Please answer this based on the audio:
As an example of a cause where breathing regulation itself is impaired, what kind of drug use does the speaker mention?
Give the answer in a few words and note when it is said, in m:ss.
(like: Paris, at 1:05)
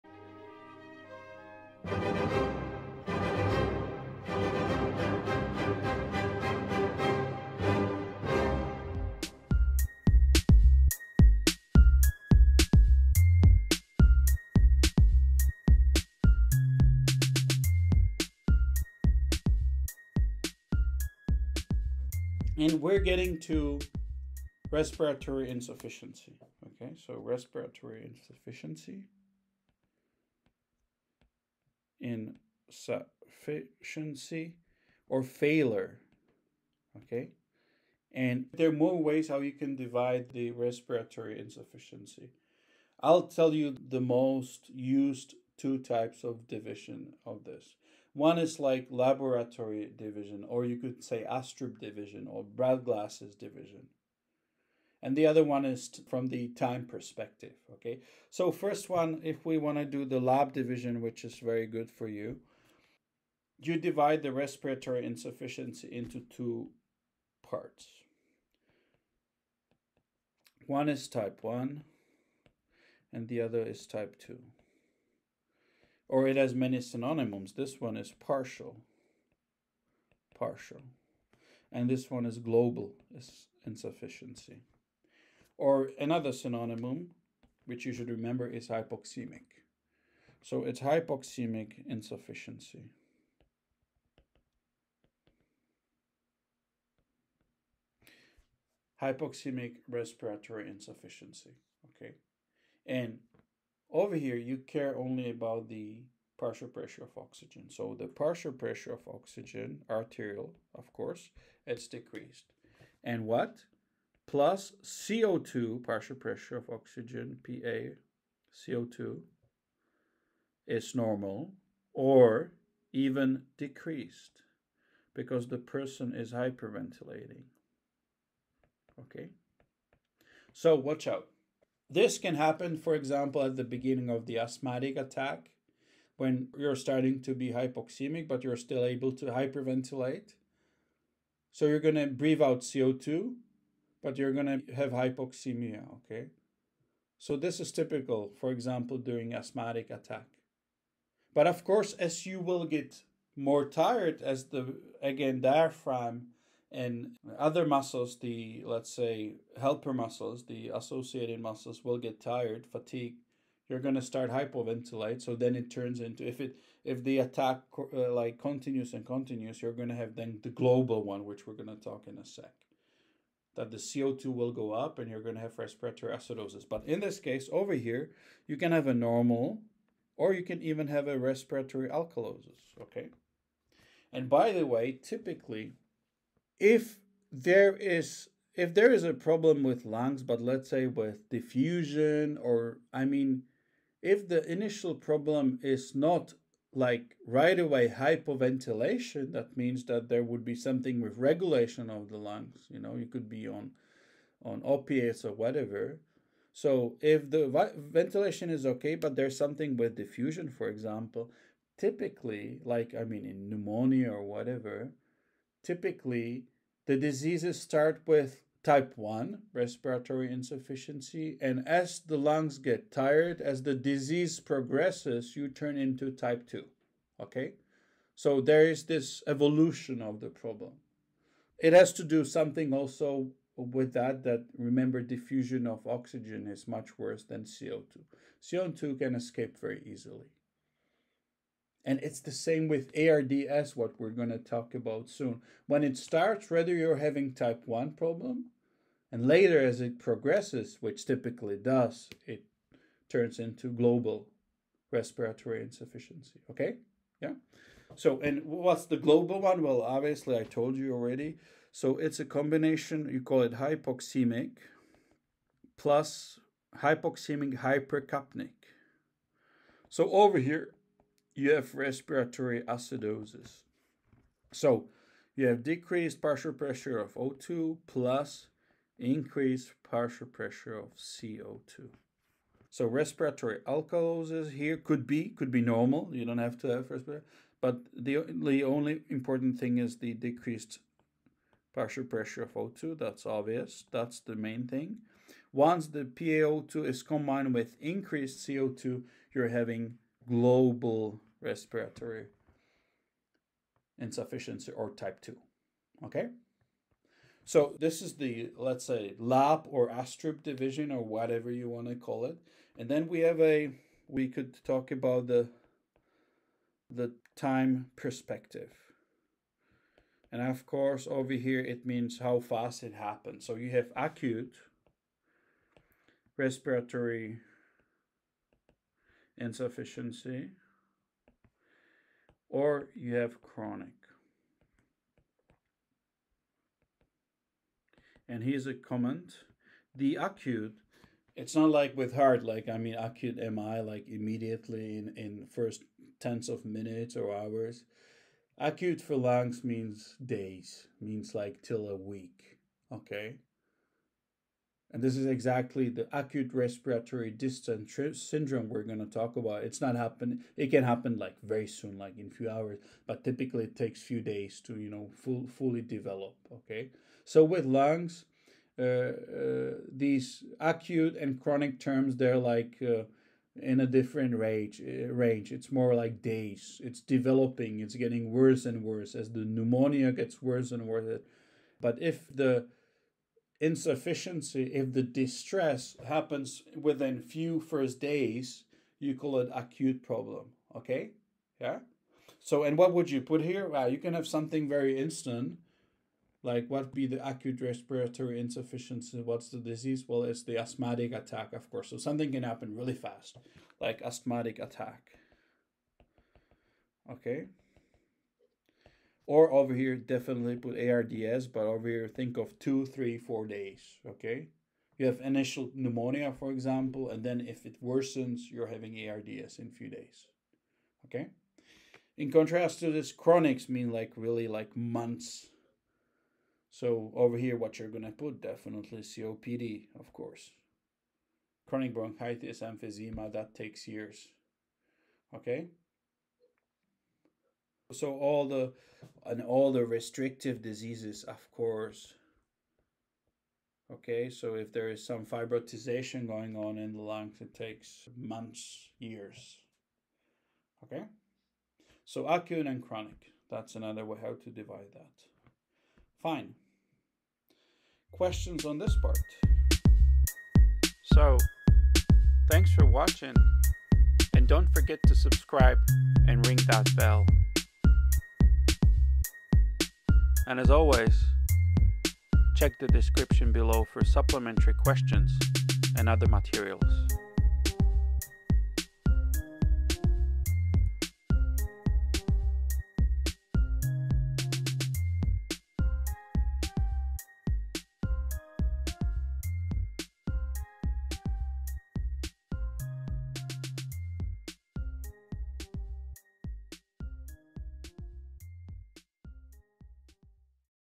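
Opiates, at 3:24.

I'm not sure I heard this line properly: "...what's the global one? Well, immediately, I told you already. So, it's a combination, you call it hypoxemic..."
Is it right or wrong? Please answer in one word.
wrong.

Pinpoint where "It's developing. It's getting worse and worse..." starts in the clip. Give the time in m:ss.
6:16.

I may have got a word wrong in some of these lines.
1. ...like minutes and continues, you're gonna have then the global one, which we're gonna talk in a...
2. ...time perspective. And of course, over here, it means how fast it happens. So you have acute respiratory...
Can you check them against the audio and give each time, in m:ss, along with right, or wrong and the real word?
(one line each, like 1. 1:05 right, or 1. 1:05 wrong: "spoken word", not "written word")
1. 2:48 wrong: "continues", not "minutes"
2. 5:17 right.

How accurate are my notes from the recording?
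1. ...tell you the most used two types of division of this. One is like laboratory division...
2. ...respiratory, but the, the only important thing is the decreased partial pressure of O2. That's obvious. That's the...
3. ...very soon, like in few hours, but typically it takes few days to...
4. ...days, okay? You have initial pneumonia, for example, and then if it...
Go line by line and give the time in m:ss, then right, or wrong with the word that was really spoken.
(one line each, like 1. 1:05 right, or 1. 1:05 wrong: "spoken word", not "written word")
1. 0:43 right
2. 4:46 right
3. 6:01 right
4. 6:53 right.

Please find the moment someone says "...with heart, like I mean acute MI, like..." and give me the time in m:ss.
5:41.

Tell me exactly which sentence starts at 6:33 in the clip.
Well, you can have something very instant.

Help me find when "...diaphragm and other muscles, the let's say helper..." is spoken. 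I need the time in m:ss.
2:35.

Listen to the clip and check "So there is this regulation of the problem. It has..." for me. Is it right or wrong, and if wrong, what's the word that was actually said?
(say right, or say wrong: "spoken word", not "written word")
wrong: "evolution", not "regulation".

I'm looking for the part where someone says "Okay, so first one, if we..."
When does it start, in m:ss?
0:57.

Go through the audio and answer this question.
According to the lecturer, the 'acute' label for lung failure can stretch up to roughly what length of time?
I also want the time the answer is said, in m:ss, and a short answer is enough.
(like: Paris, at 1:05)
A week, at 5:51.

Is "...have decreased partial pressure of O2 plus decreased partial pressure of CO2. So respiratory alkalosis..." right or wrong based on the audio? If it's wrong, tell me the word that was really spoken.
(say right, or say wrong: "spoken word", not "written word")
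wrong: "increased", not "decreased".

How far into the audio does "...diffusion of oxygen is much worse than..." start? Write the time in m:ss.
3:55.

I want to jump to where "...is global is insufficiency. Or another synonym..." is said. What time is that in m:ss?
1:22.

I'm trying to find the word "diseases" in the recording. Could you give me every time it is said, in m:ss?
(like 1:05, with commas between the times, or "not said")
3:36, 3:43, 6:39, 7:20.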